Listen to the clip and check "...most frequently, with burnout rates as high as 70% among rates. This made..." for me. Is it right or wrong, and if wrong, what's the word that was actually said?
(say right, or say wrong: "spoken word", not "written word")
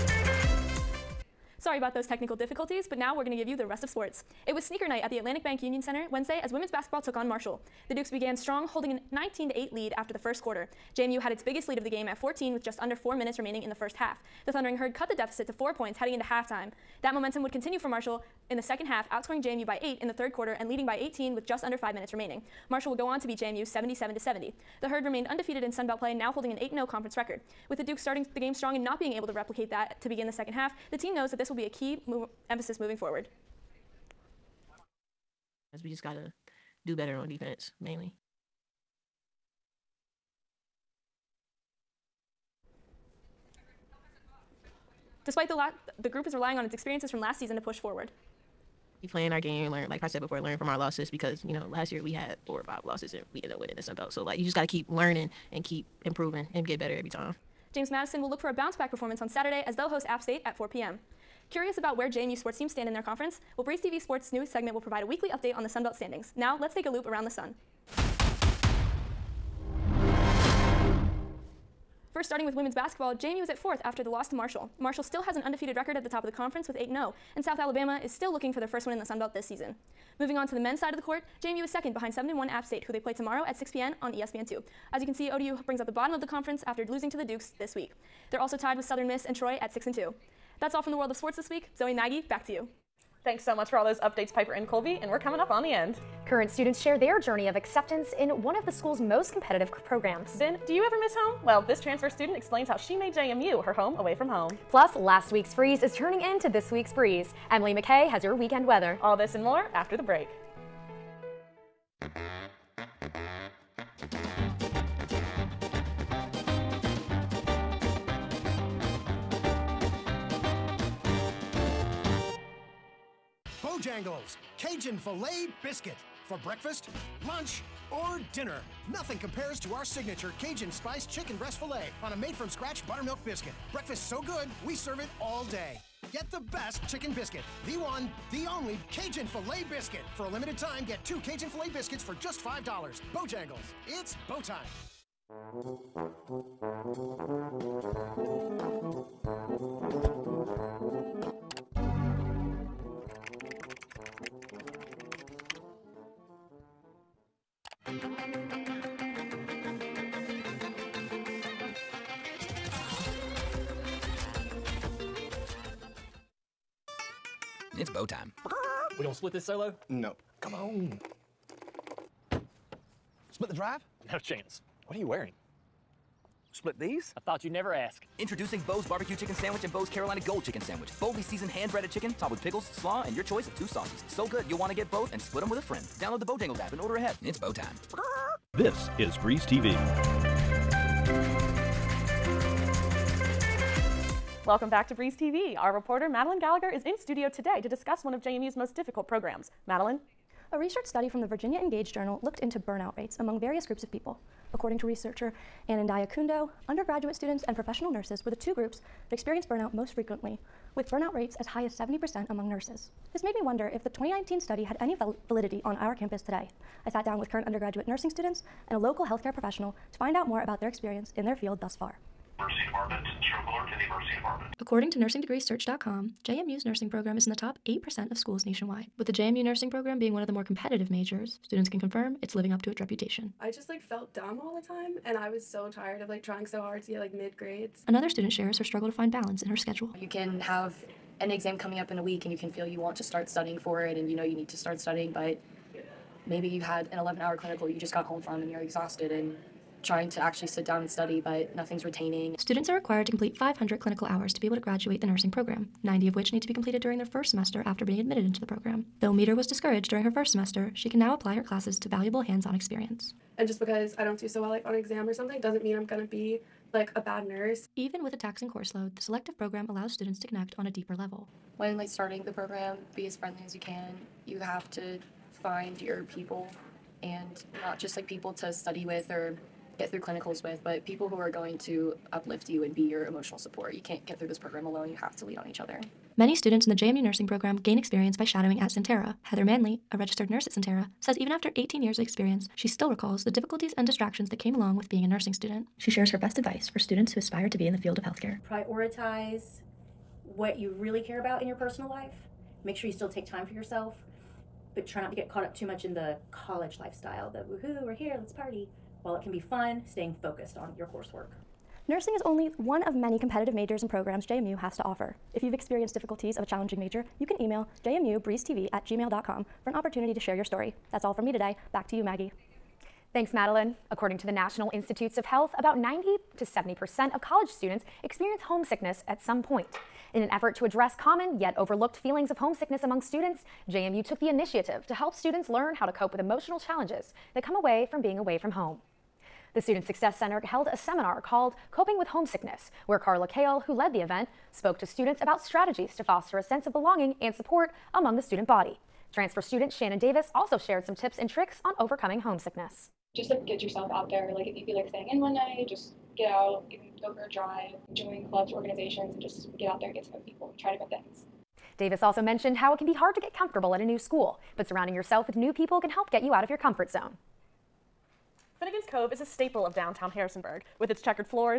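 wrong: "nurses", not "rates".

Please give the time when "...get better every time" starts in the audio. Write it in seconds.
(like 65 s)
56 s.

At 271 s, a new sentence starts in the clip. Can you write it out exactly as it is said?
When like starting the program, be as friendly as you can.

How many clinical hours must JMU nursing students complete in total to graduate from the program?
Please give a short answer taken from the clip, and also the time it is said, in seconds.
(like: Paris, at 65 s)
500, at 253 s.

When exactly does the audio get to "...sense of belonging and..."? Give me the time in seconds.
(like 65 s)
346 s.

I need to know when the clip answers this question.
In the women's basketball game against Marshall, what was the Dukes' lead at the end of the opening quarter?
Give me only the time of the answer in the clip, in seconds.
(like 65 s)
9 s.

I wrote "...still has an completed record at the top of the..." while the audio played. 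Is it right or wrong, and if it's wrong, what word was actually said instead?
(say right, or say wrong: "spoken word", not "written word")
wrong: "undefeated", not "completed".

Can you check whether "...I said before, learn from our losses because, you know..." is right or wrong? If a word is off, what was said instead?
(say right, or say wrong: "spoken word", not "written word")
right.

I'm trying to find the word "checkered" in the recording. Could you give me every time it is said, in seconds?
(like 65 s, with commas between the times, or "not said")
371 s.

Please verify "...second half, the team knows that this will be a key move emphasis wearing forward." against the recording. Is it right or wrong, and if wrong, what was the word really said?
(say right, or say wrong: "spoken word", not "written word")
wrong: "moving", not "wearing".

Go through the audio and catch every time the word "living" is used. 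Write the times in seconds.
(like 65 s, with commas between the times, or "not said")
232 s.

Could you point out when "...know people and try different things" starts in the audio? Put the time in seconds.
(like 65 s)
360 s.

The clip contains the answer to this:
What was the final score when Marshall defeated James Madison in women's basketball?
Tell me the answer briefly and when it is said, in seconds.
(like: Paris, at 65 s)
77-70, at 23 s.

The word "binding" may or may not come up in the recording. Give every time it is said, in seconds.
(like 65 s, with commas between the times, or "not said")
not said.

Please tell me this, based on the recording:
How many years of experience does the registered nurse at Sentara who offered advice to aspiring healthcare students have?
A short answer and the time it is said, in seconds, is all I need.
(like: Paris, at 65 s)
18, at 291 s.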